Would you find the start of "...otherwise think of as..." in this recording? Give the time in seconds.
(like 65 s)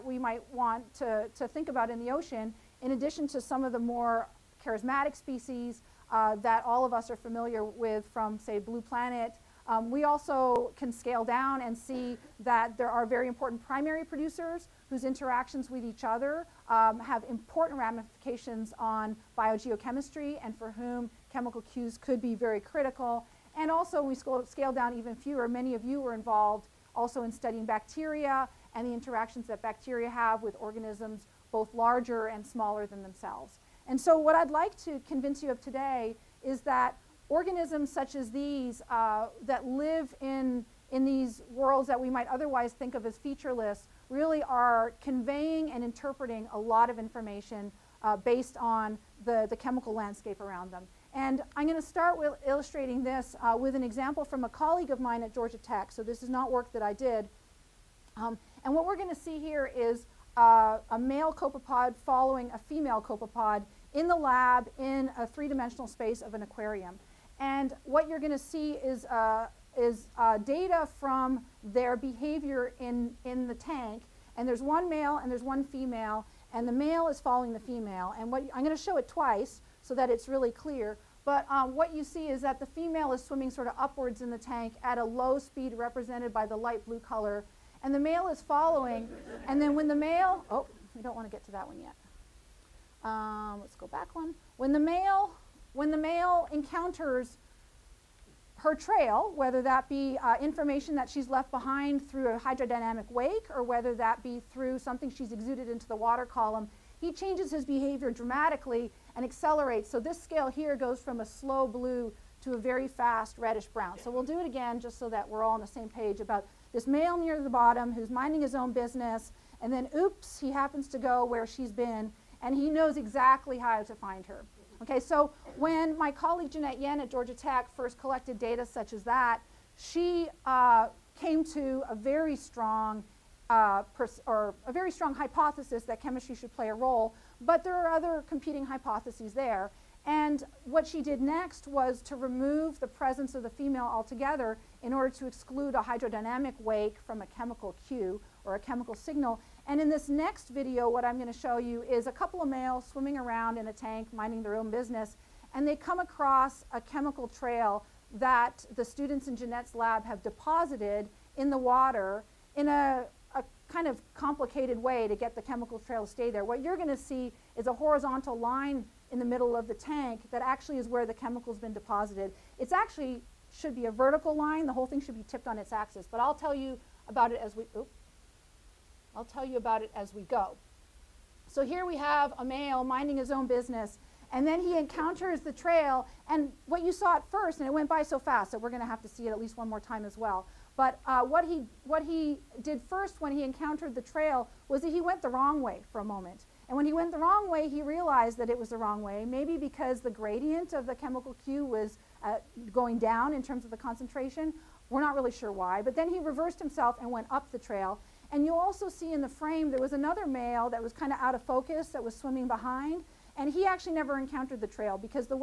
42 s.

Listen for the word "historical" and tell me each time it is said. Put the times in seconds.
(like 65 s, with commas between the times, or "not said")
not said.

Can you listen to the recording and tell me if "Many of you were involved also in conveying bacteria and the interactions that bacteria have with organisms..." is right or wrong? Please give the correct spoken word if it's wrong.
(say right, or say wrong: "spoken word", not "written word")
wrong: "studying", not "conveying".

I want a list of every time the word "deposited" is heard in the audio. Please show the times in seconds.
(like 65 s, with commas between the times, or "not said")
160 s, 171 s.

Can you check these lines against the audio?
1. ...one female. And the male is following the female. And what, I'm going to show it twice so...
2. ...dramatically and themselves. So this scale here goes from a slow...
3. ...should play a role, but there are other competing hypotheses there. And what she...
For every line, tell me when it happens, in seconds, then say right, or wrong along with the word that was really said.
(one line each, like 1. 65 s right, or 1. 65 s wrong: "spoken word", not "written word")
1. 75 s right
2. 108 s wrong: "accelerates", not "themselves"
3. 136 s right.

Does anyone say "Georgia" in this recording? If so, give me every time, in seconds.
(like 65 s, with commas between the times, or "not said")
55 s, 127 s.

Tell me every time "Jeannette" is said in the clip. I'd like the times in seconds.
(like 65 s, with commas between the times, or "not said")
126 s, 159 s.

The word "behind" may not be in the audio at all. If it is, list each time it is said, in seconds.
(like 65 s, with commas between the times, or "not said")
101 s, 212 s.